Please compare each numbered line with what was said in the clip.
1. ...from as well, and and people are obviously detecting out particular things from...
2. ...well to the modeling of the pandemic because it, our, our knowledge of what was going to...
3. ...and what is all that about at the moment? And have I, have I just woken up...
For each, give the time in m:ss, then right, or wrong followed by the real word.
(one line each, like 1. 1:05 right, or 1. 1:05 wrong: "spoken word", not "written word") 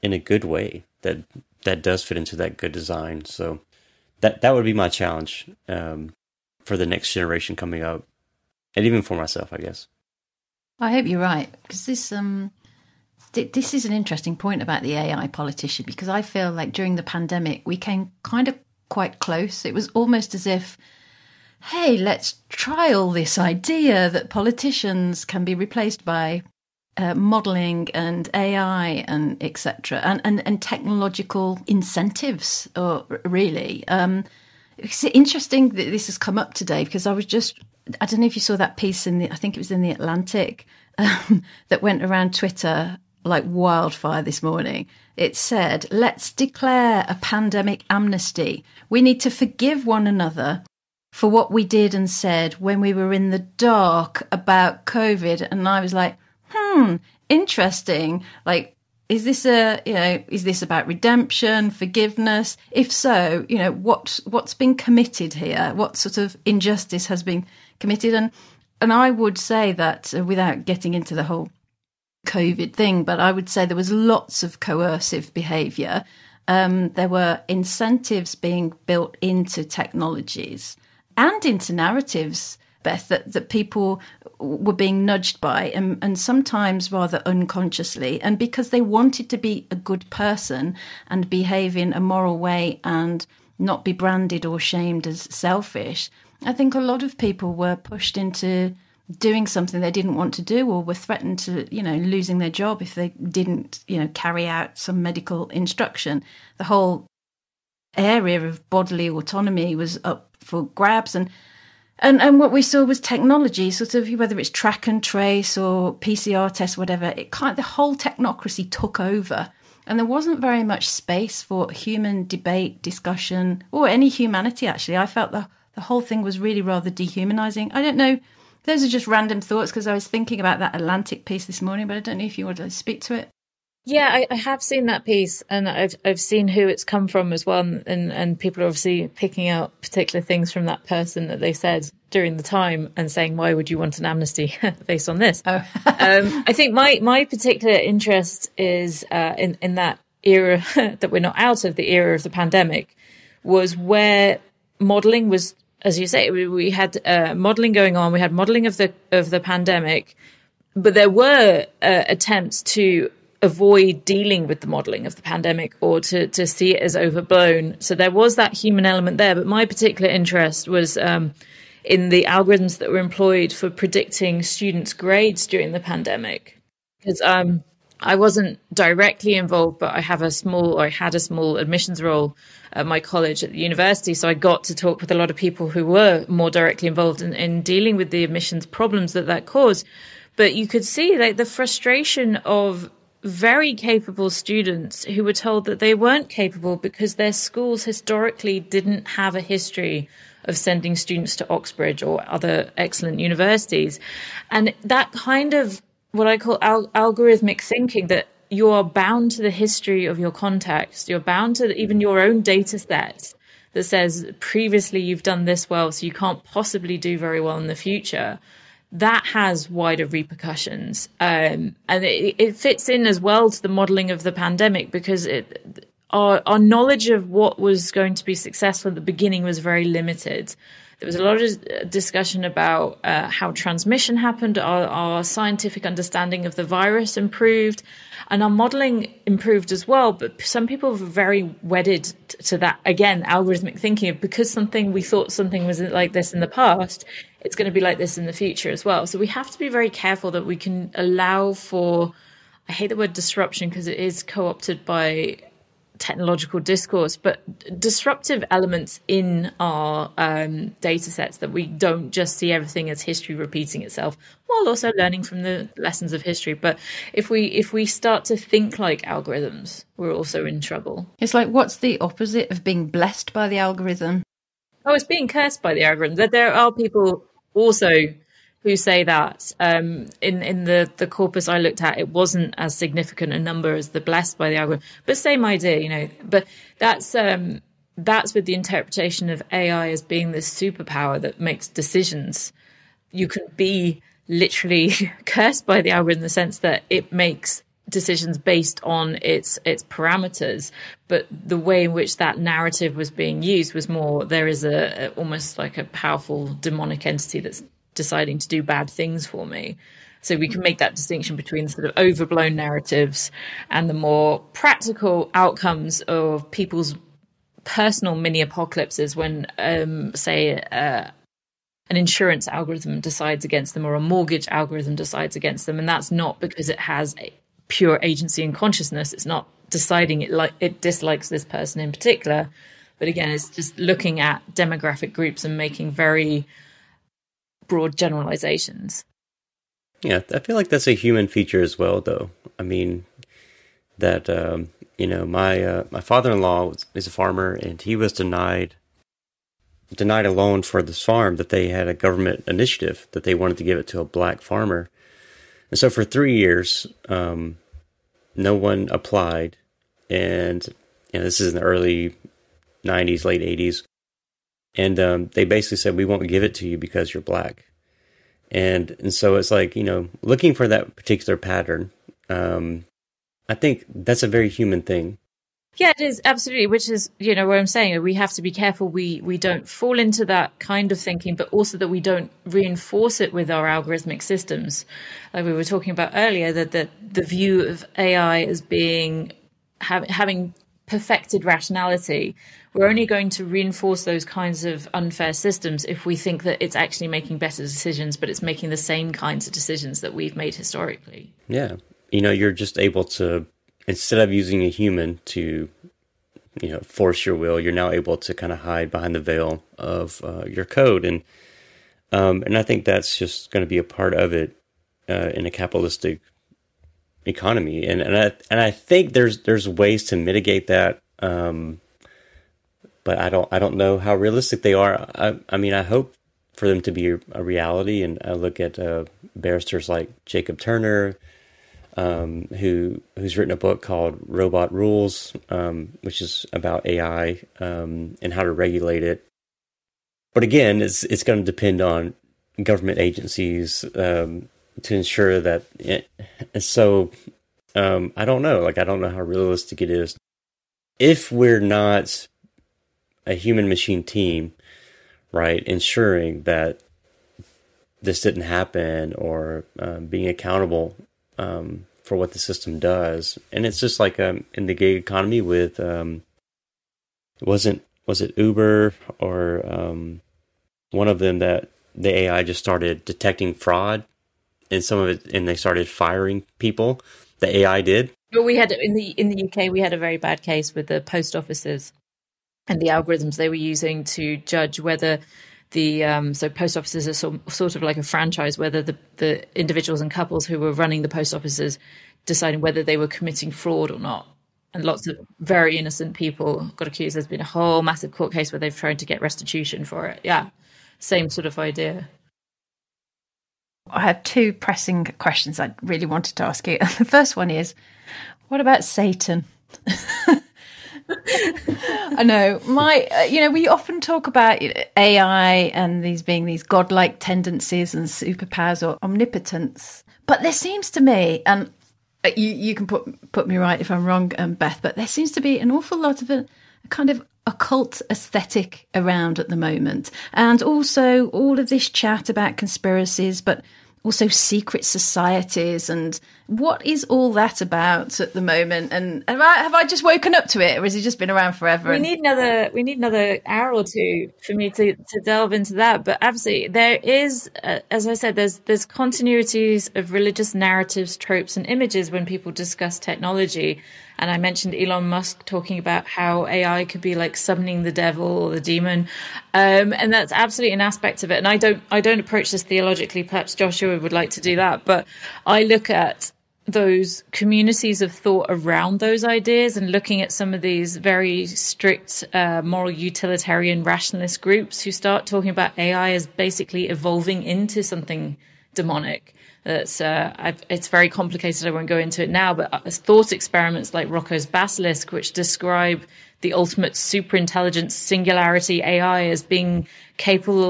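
1. 2:17 wrong: "picking", not "detecting"
2. 3:43 right
3. 8:55 right.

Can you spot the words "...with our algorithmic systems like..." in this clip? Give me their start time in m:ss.
6:23.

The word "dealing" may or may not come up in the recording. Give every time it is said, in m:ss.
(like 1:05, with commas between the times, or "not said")
2:44, 3:07.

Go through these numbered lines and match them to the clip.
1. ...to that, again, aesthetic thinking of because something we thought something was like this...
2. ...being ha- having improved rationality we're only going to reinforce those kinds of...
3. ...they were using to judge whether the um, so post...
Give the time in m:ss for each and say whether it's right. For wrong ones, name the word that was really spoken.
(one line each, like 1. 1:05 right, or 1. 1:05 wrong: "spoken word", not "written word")
1. 4:02 wrong: "algorithmic", not "aesthetic"
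2. 6:28 wrong: "perfected", not "improved"
3. 8:03 right.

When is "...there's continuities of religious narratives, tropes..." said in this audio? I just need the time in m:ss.
9:08.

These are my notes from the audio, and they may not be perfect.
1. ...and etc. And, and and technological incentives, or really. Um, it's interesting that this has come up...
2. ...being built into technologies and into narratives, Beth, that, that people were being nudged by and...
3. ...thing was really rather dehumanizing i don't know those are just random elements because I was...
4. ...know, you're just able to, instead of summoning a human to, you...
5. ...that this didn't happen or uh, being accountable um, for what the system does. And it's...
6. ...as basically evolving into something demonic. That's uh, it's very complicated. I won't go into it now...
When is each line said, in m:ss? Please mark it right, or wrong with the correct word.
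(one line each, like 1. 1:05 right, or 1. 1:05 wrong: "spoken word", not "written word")
1. 0:29 right
2. 1:18 right
3. 2:06 wrong: "thoughts", not "elements"
4. 6:42 wrong: "using", not "summoning"
5. 7:36 right
6. 9:36 right.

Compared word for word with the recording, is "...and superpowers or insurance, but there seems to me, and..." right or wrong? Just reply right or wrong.
wrong.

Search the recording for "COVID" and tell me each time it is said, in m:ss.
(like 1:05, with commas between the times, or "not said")
0:54, 1:12.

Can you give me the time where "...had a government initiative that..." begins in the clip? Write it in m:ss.
5:51.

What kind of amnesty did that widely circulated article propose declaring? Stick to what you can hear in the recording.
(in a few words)
Pandemic amnesty.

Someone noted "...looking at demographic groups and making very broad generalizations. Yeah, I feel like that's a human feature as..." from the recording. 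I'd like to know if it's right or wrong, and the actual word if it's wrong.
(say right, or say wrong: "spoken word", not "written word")
right.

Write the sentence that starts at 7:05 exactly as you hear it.
I, I mean I hope for them to be a reality, and I uh, look at uh, barristers like Jacob Turner.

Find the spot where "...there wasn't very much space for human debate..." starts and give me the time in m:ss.
1:59.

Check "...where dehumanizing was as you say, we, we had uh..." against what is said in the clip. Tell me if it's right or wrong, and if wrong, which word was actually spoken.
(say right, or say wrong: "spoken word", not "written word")
wrong: "modelling", not "dehumanizing".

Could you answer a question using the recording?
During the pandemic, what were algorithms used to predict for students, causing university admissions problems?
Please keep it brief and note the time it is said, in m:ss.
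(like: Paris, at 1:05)
Students' grades, at 2:54.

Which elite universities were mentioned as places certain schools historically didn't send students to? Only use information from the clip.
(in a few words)
Oxbridge.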